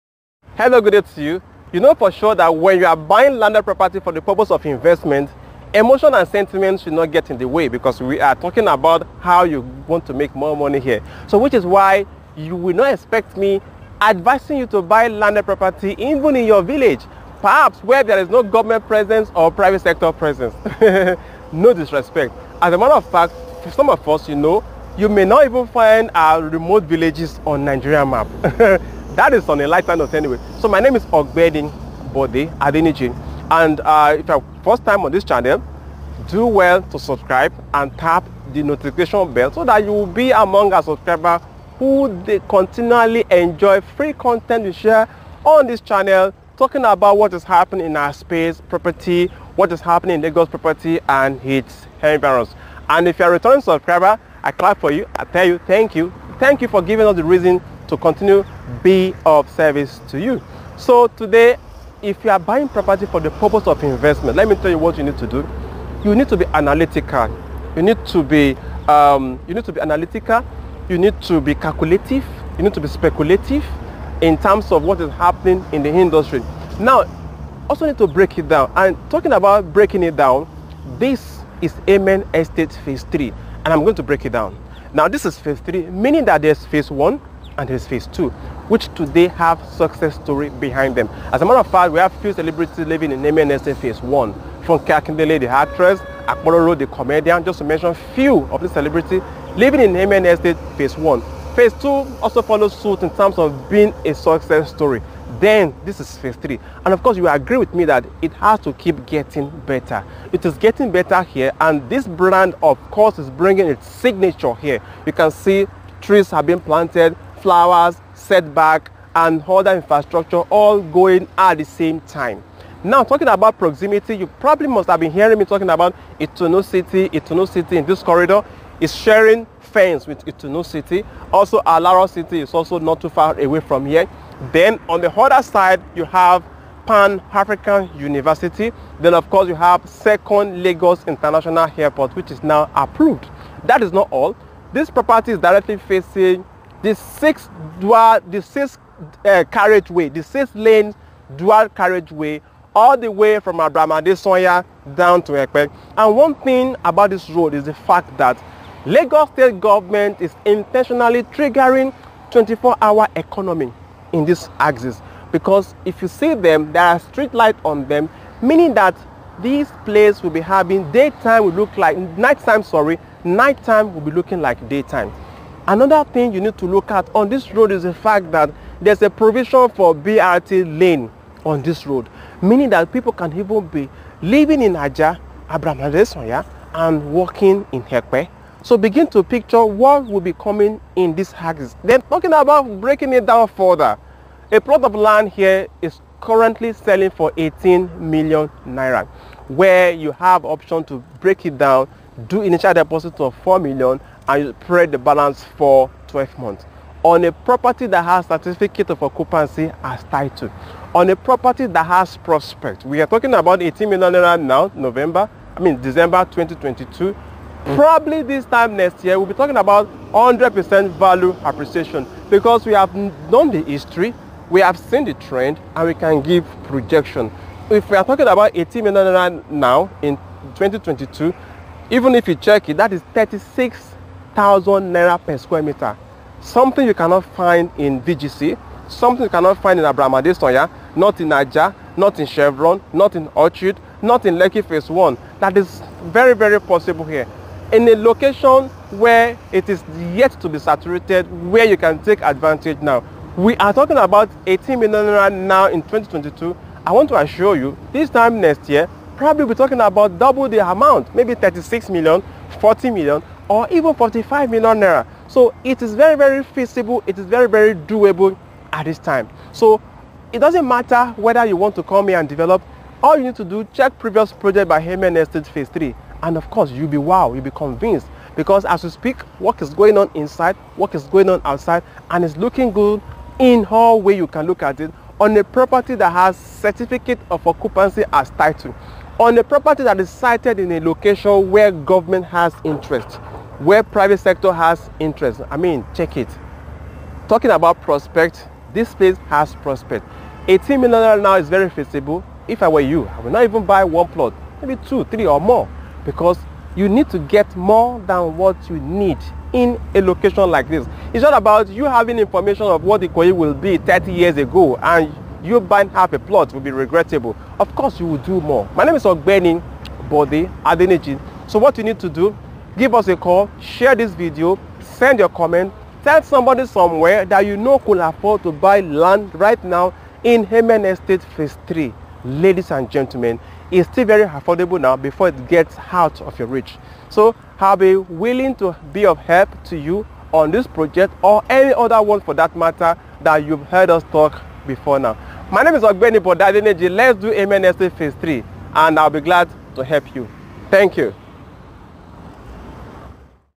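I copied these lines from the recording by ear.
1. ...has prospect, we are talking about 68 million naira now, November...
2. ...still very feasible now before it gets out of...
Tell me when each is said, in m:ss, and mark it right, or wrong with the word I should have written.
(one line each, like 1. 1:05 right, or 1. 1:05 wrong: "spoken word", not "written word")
1. 3:31 wrong: "18", not "68"
2. 5:33 wrong: "affordable", not "feasible".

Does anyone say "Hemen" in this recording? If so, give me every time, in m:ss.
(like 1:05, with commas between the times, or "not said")
5:30, 5:47.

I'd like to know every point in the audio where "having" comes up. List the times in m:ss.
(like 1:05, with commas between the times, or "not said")
2:50, 5:11.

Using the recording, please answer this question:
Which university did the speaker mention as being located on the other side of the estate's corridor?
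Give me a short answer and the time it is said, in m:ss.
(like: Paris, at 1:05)
Pan-African University, at 2:16.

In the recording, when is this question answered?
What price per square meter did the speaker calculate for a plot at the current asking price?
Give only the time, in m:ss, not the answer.
3:53.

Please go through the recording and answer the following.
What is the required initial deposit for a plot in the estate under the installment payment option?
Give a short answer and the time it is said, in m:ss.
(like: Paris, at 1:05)
4 million naira, at 3:23.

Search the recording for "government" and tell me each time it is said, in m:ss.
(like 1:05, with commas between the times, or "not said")
0:18, 2:39, 4:51.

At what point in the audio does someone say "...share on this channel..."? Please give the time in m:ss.
0:44.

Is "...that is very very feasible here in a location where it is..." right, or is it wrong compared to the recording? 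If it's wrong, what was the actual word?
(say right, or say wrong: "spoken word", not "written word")
wrong: "possible", not "feasible".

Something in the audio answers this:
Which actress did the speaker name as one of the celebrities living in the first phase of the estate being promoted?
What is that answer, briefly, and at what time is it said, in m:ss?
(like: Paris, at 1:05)
Kakindele, at 1:34.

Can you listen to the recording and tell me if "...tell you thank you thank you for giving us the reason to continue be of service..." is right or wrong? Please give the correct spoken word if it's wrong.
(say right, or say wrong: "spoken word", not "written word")
right.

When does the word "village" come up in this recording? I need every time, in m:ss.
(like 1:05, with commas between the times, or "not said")
0:16, 0:26.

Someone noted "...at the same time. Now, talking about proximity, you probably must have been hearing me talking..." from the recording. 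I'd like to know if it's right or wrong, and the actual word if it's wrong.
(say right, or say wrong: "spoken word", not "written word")
right.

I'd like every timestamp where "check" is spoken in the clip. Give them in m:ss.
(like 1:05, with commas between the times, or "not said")
3:52, 4:33, 4:55.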